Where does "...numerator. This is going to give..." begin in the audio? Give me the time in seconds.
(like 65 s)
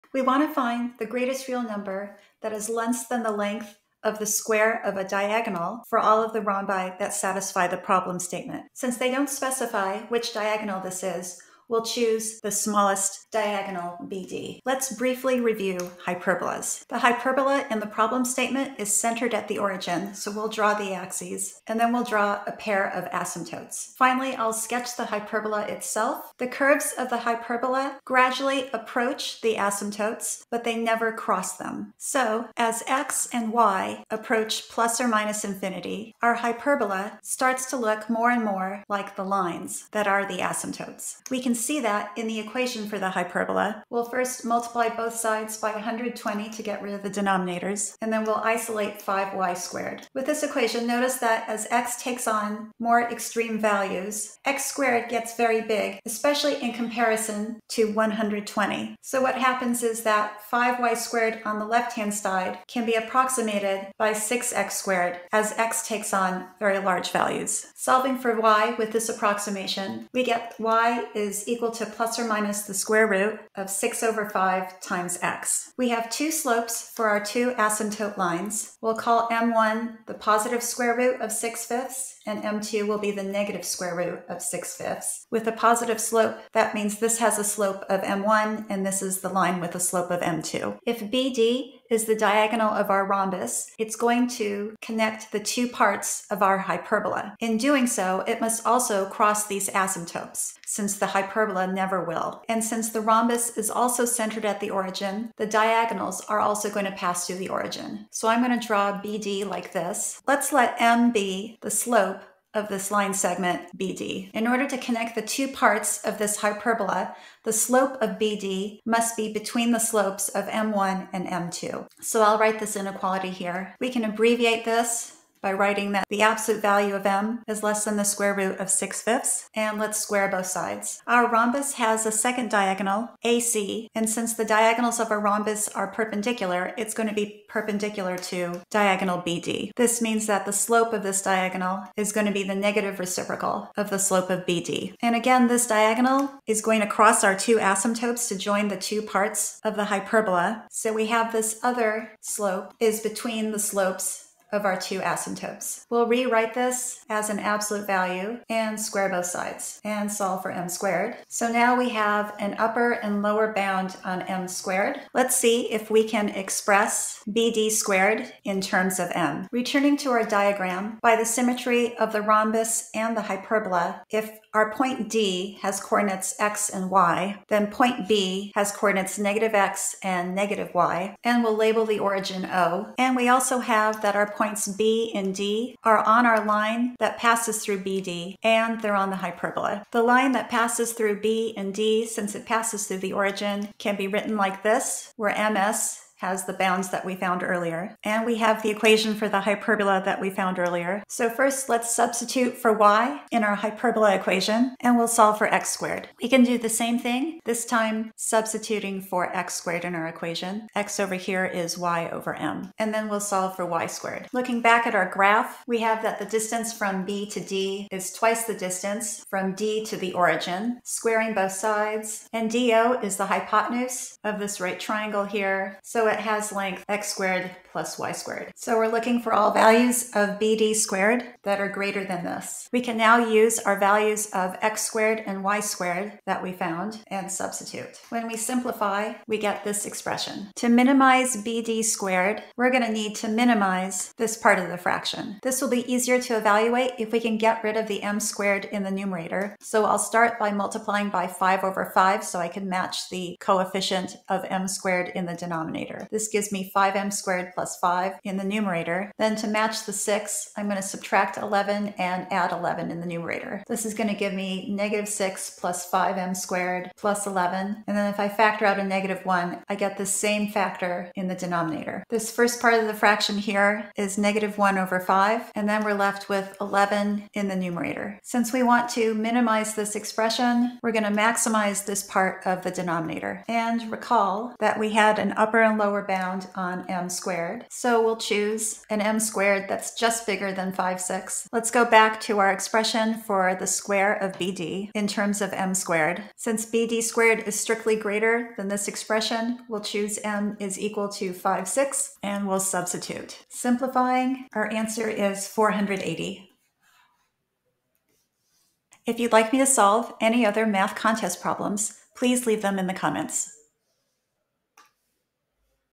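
263 s.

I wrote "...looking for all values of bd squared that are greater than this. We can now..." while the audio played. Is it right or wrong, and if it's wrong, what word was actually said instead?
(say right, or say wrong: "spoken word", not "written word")
right.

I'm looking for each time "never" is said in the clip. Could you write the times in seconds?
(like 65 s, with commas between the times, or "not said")
30 s, 101 s.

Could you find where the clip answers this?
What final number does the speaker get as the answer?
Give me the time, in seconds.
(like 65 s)
305 s.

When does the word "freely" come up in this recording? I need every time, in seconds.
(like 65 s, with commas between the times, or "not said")
not said.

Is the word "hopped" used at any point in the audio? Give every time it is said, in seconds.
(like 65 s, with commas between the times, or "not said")
not said.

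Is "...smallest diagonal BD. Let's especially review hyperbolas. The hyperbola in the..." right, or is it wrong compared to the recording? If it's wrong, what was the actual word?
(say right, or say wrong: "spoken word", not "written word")
wrong: "briefly", not "especially".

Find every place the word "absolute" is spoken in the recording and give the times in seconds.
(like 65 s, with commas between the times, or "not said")
126 s, 157 s.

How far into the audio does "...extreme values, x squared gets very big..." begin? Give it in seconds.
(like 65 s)
53 s.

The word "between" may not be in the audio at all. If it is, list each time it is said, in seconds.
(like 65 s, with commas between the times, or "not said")
119 s, 153 s.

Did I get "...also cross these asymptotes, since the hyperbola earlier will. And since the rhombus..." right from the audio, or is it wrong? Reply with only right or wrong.
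wrong.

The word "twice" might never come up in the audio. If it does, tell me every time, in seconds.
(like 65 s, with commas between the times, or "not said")
218 s.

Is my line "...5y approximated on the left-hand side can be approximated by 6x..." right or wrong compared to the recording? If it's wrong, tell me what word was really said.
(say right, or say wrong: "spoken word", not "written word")
wrong: "squared", not "approximated".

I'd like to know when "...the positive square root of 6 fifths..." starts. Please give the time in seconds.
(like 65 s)
80 s.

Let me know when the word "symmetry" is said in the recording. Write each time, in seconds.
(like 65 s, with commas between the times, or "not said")
171 s.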